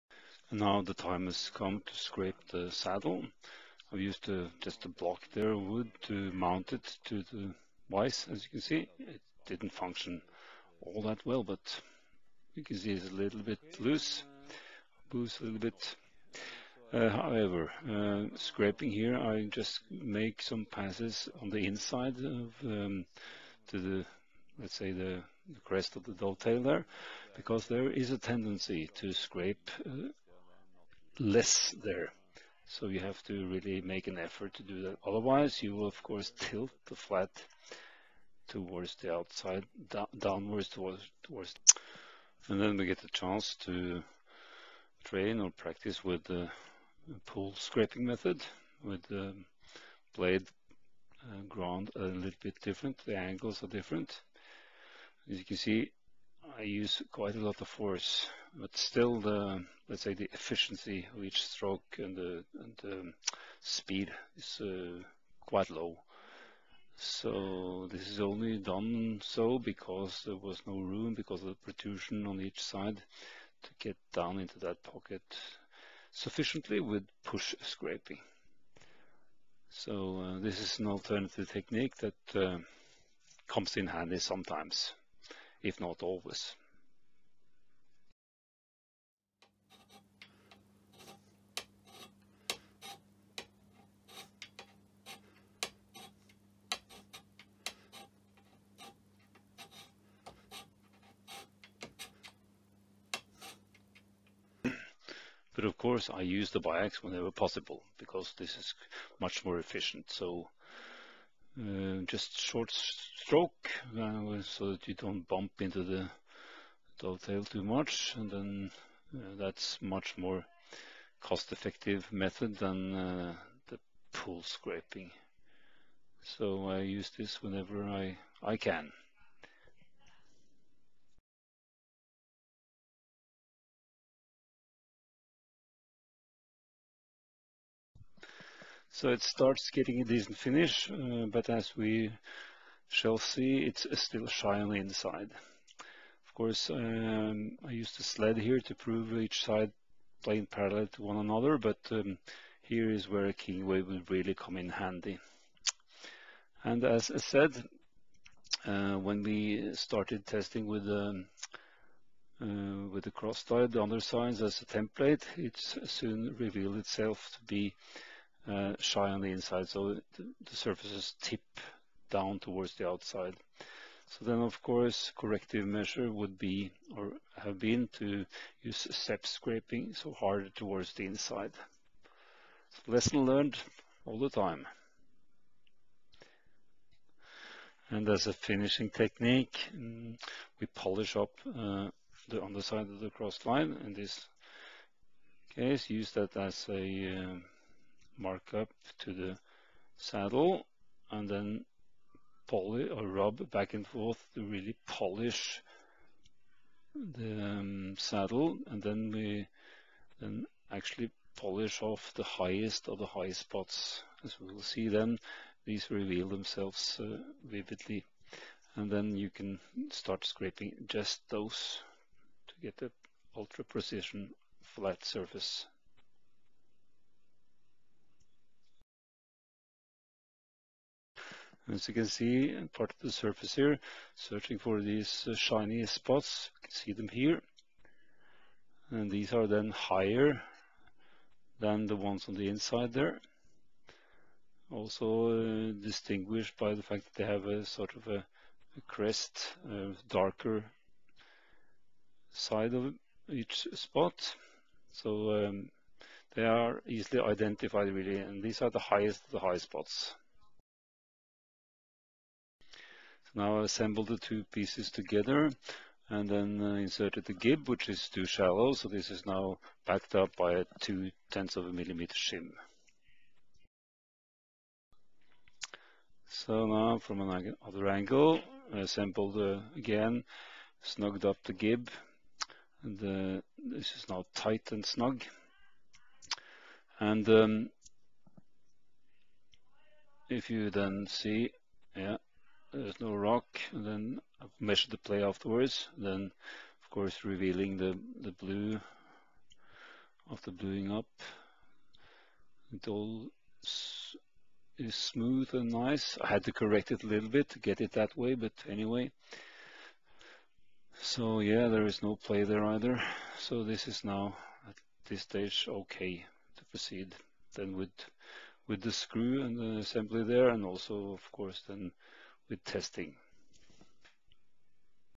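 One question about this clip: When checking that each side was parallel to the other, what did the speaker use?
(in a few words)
a sled.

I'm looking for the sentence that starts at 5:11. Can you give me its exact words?
So yeah, there is no play there either.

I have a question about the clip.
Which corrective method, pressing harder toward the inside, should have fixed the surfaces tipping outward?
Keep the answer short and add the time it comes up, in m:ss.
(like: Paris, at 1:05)
step scraping, at 2:58.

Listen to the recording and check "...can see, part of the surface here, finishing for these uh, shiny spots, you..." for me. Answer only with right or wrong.
wrong.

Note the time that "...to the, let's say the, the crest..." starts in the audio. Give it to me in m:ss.
0:23.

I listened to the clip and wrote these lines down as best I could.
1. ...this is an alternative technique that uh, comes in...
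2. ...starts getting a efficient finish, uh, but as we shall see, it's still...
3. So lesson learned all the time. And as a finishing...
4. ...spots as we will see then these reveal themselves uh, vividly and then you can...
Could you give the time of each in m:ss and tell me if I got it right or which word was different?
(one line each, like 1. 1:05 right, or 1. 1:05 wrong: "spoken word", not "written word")
1. 1:20 right
2. 2:19 wrong: "decent", not "efficient"
3. 3:02 right
4. 3:33 right.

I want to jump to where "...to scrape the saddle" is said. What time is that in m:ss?
0:01.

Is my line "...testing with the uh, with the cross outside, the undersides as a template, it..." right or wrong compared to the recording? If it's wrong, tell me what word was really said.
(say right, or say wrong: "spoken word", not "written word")
wrong: "slide", not "outside".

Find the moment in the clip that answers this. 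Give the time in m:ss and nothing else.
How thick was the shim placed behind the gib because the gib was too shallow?
4:30.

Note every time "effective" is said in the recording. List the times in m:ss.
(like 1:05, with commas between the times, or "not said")
2:01.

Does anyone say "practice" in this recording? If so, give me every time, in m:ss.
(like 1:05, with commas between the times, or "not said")
0:45.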